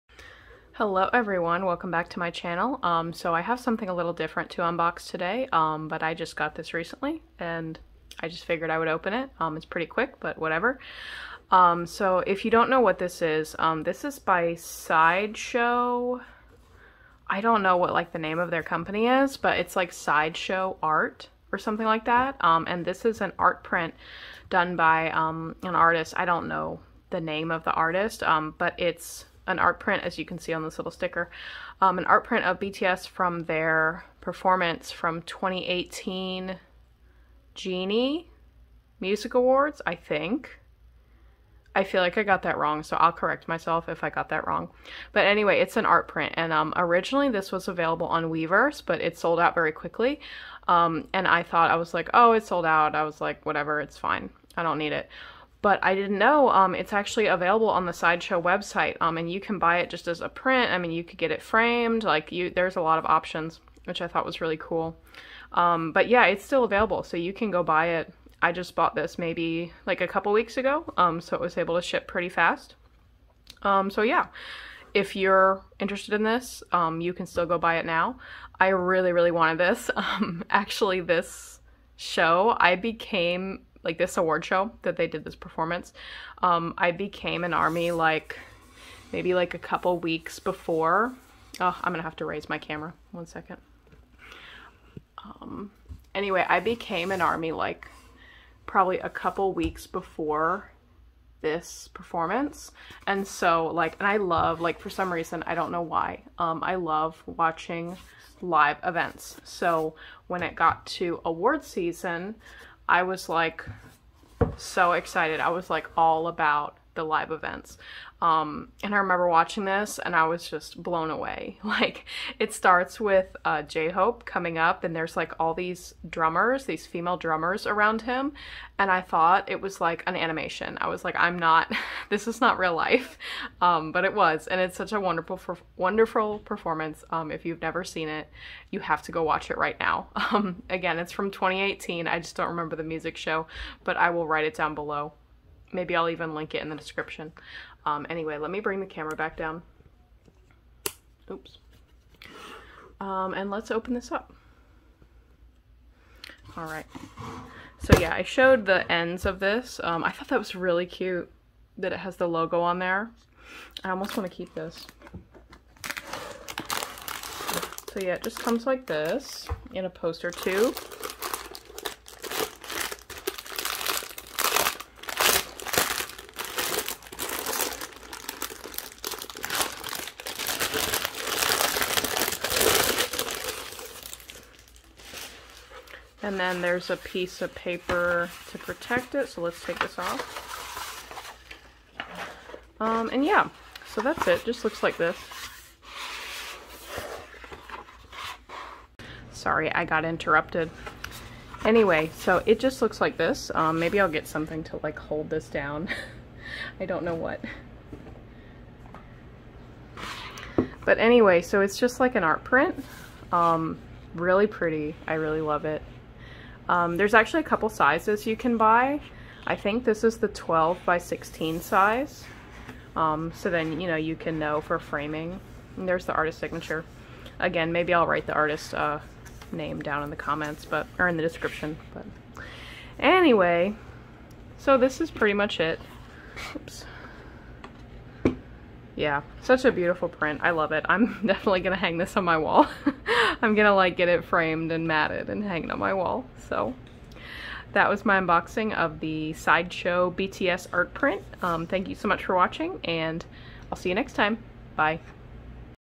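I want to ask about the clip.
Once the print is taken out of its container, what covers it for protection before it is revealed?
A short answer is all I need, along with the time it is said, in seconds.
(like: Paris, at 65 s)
A piece of paper, at 186 s.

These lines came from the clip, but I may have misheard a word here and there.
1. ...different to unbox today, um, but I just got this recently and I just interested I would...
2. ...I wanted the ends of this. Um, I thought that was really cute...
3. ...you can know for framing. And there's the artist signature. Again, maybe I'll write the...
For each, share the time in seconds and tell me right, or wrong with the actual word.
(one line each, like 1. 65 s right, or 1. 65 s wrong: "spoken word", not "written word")
1. 4 s wrong: "figured", not "interested"
2. 158 s wrong: "showed", not "wanted"
3. 223 s right.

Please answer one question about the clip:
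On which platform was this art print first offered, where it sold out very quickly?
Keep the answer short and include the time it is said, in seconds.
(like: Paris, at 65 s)
Weverse, at 48 s.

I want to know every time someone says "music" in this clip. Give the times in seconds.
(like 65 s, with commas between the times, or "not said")
38 s, 142 s.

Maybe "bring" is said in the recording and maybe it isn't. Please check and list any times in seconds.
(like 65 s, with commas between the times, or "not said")
148 s.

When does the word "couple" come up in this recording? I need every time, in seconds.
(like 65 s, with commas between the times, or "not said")
70 s, 89 s, 99 s, 217 s.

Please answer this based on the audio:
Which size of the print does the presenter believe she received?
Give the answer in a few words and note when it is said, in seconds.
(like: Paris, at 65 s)
12 by 16, at 220 s.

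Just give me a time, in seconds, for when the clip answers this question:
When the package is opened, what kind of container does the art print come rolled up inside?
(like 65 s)
169 s.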